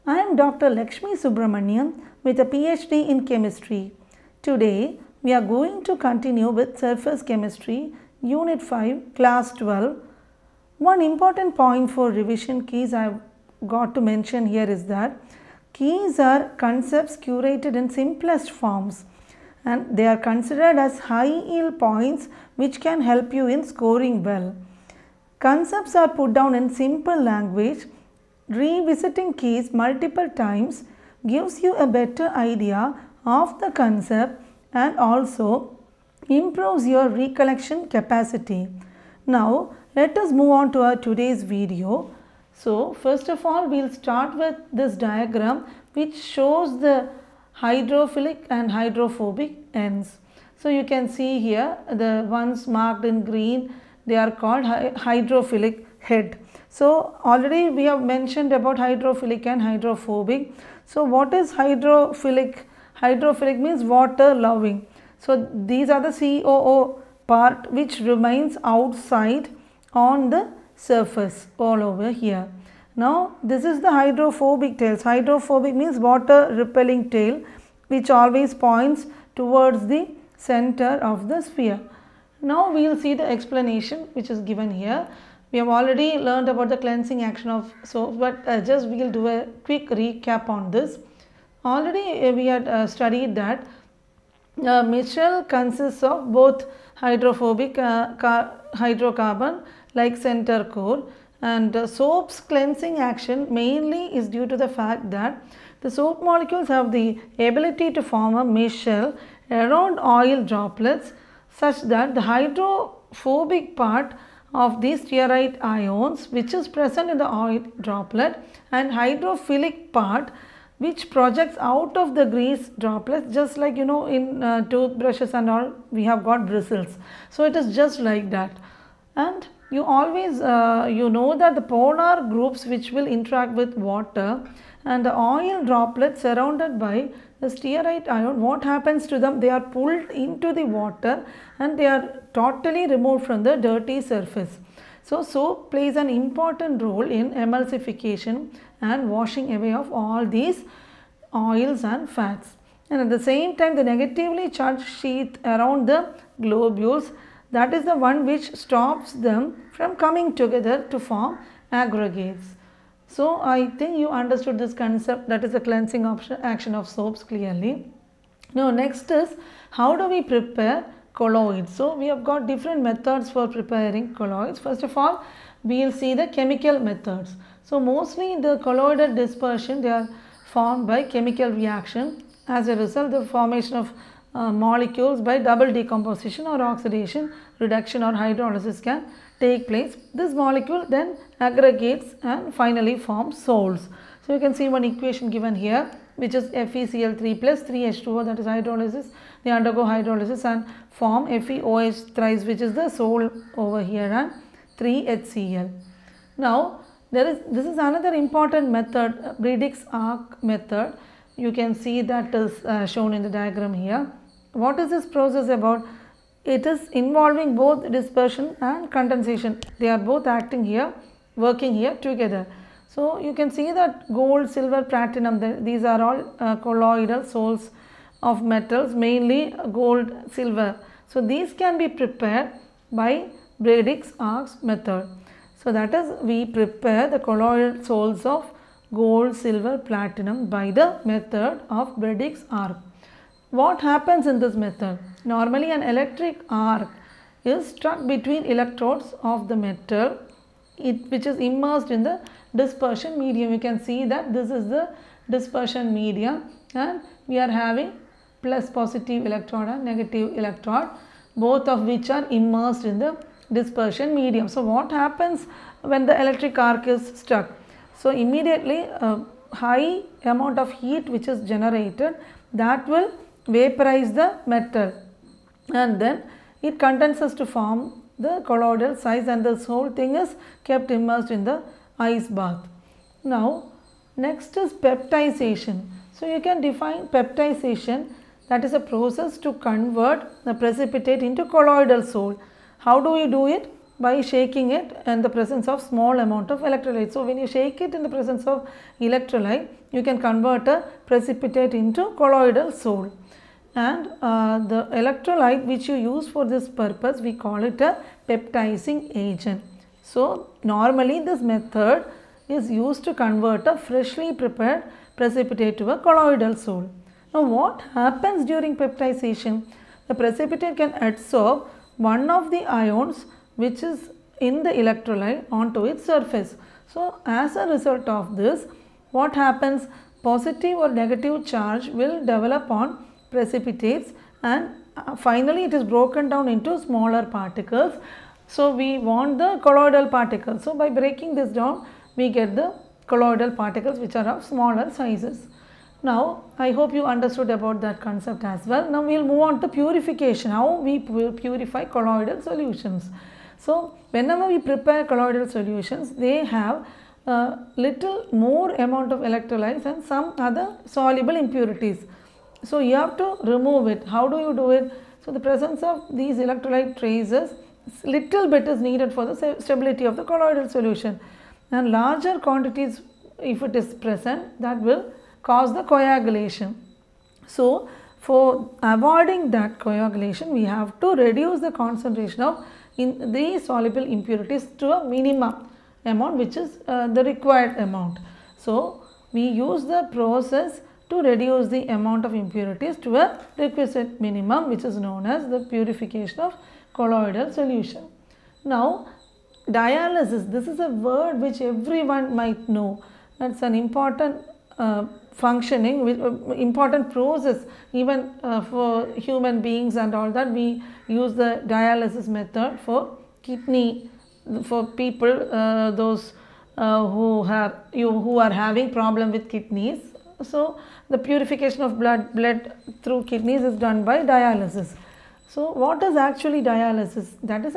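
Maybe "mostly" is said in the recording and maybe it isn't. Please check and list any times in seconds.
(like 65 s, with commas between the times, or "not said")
177 s.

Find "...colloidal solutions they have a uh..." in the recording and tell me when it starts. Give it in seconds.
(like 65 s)
355 s.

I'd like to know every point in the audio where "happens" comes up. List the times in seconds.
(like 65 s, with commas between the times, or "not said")
138 s, 243 s, 264 s, 317 s, 329 s.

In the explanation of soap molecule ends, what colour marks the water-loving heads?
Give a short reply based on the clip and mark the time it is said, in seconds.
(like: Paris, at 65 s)
Green, at 53 s.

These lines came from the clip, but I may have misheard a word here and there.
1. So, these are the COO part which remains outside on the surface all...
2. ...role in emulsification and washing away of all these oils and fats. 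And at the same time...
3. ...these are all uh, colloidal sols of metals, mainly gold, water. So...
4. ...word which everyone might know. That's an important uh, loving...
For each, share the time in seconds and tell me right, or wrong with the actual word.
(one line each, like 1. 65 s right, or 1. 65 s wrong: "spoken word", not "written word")
1. 65 s right
2. 146 s right
3. 225 s wrong: "silver", not "water"
4. 400 s wrong: "functioning", not "loving".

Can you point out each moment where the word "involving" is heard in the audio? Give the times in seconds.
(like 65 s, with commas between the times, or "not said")
216 s.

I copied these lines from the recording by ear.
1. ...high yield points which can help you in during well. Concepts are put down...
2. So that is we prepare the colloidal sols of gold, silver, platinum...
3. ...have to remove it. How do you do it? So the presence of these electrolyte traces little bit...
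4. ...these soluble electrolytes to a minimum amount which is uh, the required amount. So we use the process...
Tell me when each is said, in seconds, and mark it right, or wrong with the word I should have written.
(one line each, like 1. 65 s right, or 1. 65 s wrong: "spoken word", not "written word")
1. 21 s wrong: "scoring", not "during"
2. 235 s right
3. 362 s right
4. 383 s wrong: "impurities", not "electrolytes".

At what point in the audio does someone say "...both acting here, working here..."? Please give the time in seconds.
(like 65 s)
219 s.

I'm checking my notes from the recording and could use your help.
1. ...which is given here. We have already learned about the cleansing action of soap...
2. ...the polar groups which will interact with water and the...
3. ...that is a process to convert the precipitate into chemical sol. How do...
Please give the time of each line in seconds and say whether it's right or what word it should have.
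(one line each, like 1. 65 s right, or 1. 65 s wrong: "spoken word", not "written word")
1. 84 s right
2. 131 s right
3. 288 s wrong: "colloidal", not "chemical".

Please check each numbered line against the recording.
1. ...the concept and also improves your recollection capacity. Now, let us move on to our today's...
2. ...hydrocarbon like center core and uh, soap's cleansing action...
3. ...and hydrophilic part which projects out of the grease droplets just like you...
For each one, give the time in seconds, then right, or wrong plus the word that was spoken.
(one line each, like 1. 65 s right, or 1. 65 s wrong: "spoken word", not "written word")
1. 33 s right
2. 98 s right
3. 118 s right.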